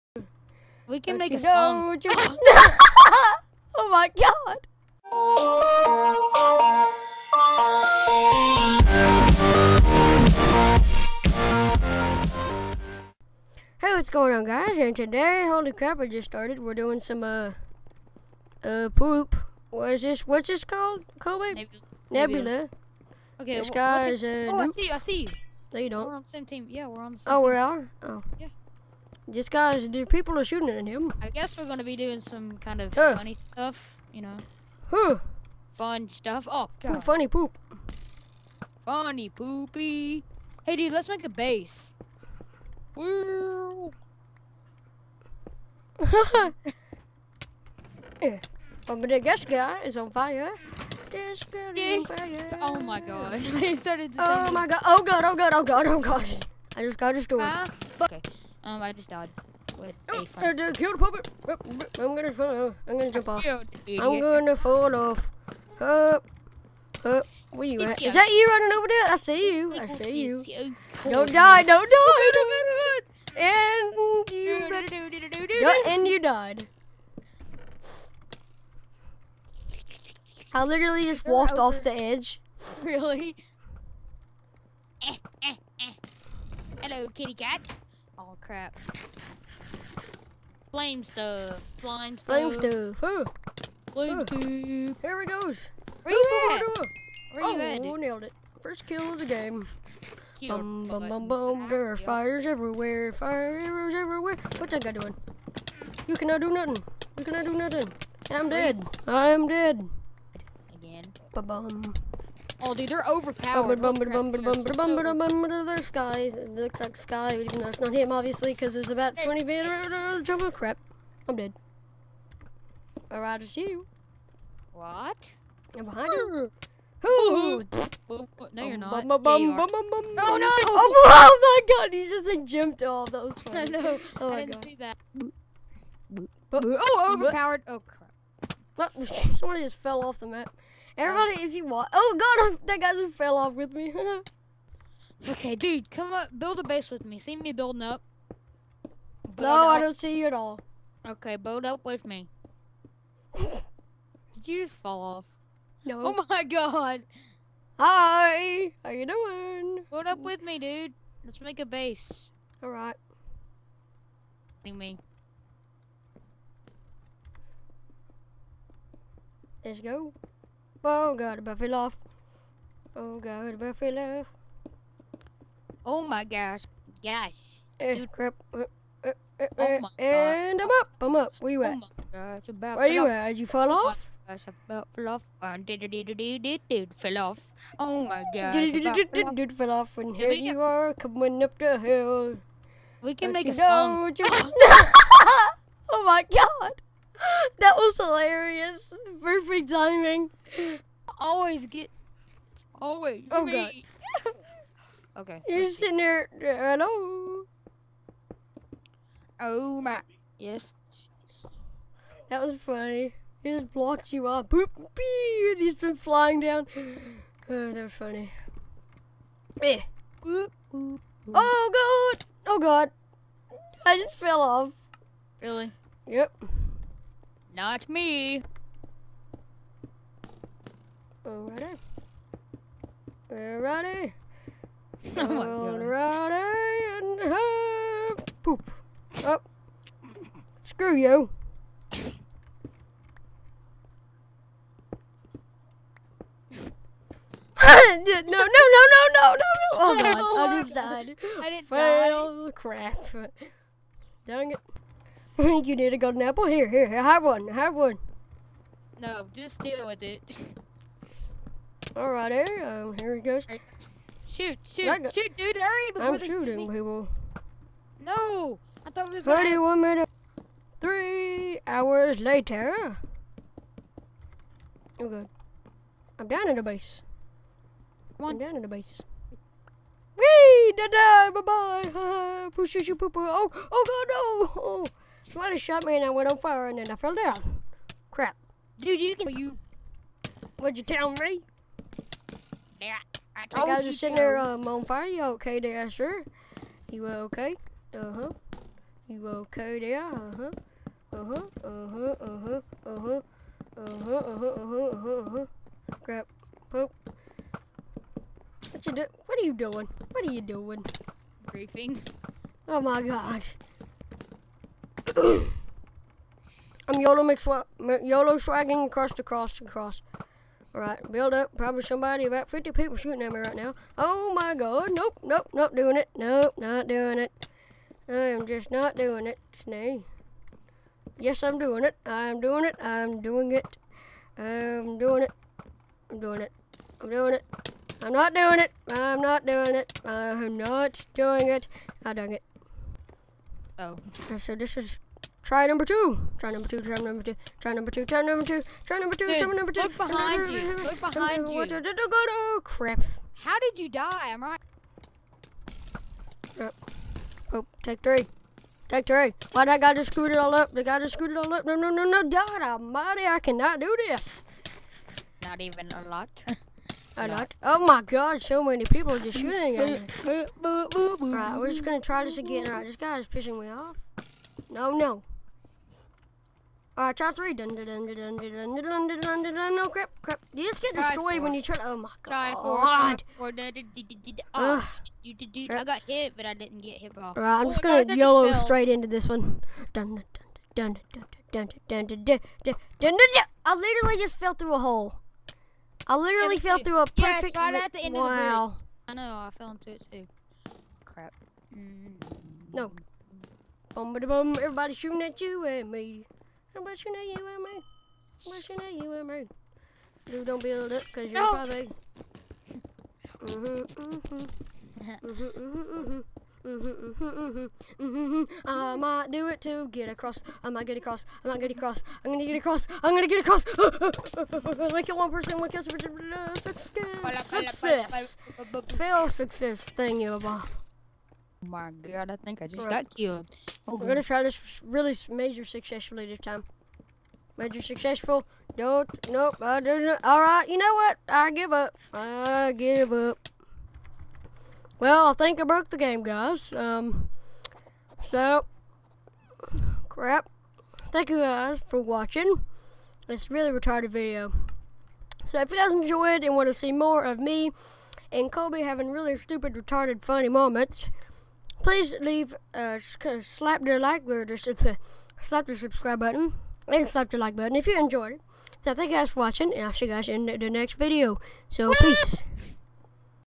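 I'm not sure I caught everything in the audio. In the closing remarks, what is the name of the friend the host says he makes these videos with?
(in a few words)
Colby.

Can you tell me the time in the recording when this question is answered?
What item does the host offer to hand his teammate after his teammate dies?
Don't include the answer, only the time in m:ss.
4:15.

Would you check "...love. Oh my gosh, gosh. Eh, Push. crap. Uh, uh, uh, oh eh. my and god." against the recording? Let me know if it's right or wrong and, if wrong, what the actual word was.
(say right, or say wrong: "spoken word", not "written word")
wrong: "Dude", not "Push".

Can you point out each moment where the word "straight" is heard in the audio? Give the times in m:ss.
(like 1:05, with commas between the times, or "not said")
6:28.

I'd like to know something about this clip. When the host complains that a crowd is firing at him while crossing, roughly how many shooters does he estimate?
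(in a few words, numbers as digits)
50.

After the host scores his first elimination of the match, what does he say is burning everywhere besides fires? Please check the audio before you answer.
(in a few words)
Fire arrows.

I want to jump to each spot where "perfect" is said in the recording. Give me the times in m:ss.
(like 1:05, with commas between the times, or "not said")
3:19, 6:37.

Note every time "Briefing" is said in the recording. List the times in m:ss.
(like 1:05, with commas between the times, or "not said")
5:11.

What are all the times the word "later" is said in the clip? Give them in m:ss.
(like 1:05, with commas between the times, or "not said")
4:32.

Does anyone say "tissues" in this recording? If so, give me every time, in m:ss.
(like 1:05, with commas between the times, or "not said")
not said.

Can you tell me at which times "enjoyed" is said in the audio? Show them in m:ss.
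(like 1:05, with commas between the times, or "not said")
7:35, 7:47.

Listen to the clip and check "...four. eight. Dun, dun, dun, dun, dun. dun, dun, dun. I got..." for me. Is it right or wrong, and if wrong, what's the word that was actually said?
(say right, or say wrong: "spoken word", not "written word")
wrong: "four", not "eight".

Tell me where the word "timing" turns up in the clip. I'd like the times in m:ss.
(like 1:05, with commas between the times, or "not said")
3:19.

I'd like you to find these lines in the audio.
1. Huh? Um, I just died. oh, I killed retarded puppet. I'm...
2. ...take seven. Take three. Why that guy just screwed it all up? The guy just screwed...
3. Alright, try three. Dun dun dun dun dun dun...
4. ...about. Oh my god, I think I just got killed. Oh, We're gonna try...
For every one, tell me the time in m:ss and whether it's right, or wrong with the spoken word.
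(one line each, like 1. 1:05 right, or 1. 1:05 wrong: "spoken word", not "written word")
1. 0:57 wrong: "killed", not "retarded"
2. 5:57 wrong: "three", not "seven"
3. 6:16 right
4. 7:10 right.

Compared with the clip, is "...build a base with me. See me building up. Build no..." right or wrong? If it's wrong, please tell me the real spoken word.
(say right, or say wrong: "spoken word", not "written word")
right.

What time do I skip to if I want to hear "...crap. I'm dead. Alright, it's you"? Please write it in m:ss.
2:00.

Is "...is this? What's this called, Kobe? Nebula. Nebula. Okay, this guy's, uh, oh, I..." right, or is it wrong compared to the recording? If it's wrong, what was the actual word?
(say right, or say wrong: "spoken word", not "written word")
right.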